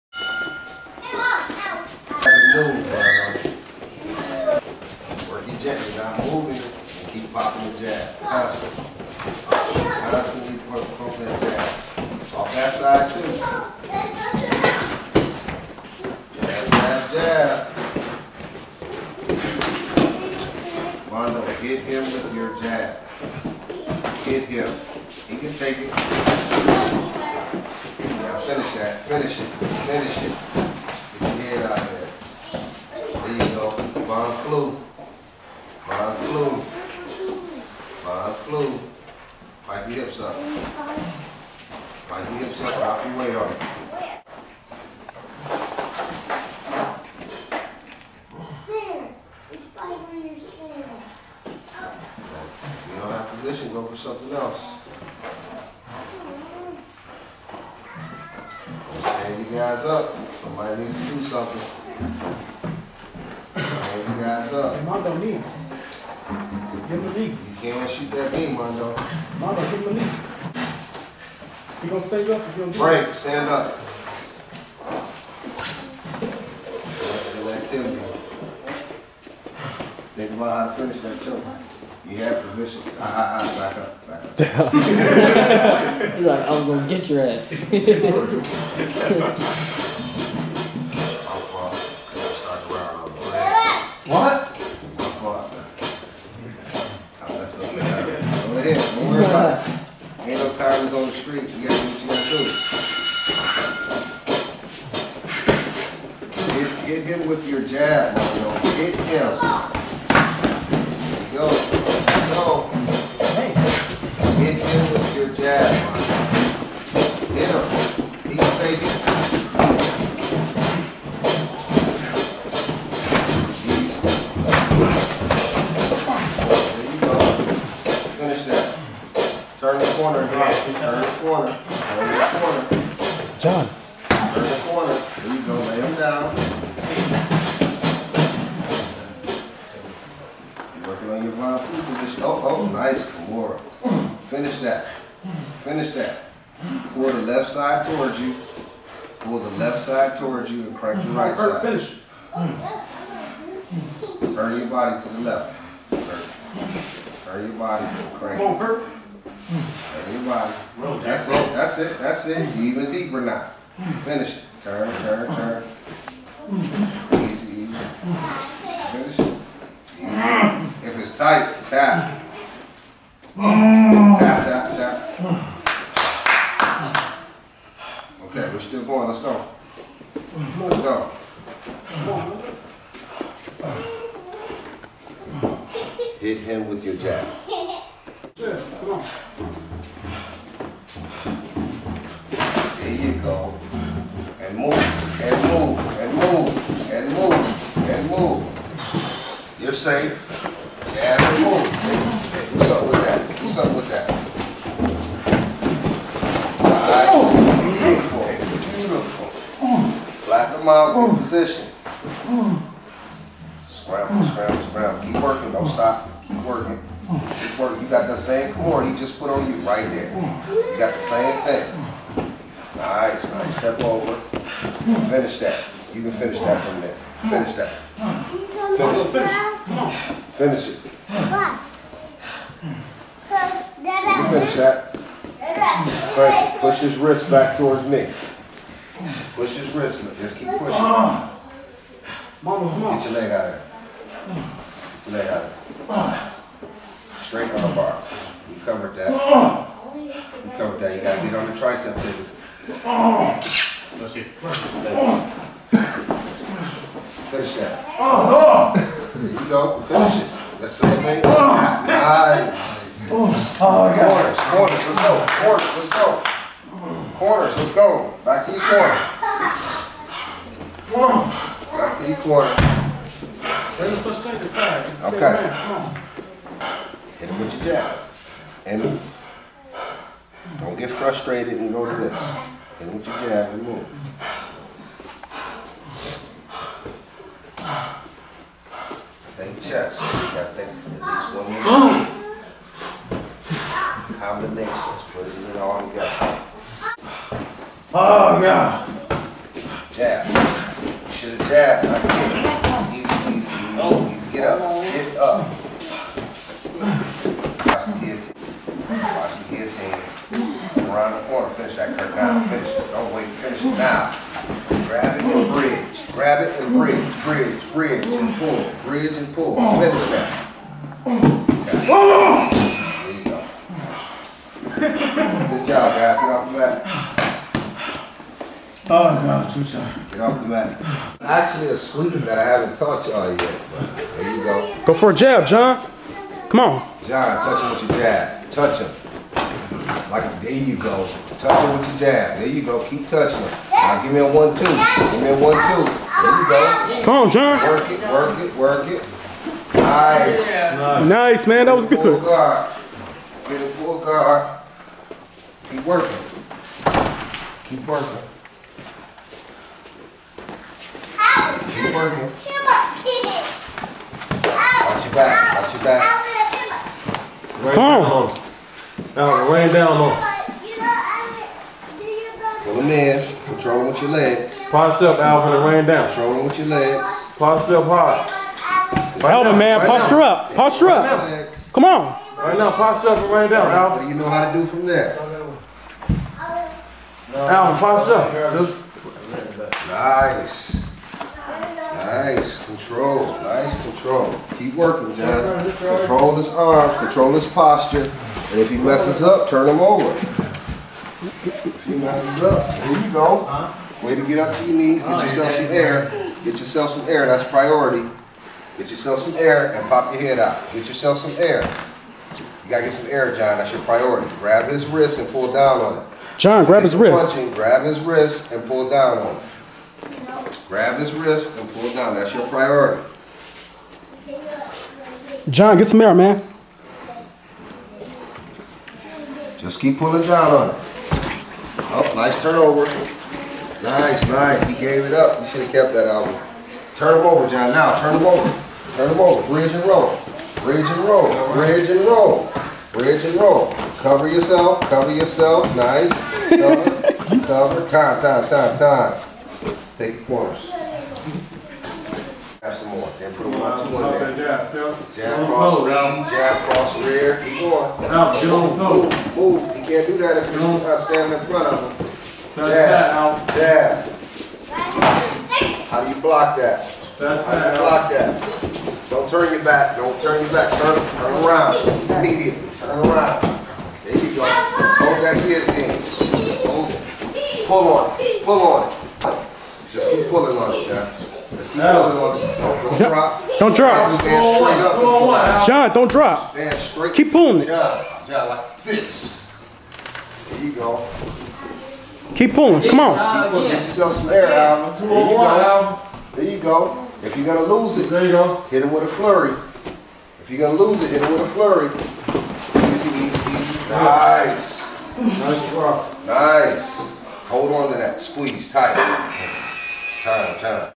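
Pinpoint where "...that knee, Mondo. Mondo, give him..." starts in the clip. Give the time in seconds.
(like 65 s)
68 s.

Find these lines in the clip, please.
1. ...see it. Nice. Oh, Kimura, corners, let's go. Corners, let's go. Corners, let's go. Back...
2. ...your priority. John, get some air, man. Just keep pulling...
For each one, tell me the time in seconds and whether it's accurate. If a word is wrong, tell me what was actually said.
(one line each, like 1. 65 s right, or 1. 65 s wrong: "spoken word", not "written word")
1. 260 s wrong: "Corners", not "Kimura"
2. 422 s right.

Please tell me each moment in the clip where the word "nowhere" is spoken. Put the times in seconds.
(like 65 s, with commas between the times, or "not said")
not said.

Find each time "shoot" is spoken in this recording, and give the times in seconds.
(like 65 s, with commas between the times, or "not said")
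67 s.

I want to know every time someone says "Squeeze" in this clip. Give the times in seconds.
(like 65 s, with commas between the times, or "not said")
508 s.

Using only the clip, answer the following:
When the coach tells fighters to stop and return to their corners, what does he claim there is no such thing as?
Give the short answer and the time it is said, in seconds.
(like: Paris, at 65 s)
size, at 274 s.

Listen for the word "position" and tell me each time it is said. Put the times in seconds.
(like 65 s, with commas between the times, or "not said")
82 s, 141 s, 211 s.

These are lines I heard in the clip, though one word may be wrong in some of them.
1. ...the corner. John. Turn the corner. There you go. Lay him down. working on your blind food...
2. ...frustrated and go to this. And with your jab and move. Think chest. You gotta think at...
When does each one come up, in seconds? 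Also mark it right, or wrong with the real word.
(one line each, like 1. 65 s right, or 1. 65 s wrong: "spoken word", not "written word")
1. 131 s right
2. 280 s right.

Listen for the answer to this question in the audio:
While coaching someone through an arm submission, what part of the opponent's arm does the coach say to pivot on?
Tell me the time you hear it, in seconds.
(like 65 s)
251 s.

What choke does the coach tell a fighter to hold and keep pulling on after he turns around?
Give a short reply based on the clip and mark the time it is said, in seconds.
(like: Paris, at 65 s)
guillotine, at 475 s.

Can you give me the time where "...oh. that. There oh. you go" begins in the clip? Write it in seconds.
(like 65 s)
319 s.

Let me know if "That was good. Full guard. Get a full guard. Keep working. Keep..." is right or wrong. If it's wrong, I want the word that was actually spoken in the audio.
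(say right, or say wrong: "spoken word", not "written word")
right.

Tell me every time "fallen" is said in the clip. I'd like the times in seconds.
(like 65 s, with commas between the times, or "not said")
not said.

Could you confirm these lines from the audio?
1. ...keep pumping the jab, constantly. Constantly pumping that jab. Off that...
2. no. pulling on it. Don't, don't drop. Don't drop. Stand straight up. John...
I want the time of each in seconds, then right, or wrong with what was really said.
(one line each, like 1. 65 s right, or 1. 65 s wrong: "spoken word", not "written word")
1. 7 s wrong: "popping", not "pumping"
2. 481 s right.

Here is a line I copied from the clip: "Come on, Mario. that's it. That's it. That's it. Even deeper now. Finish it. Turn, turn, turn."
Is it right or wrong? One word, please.
wrong.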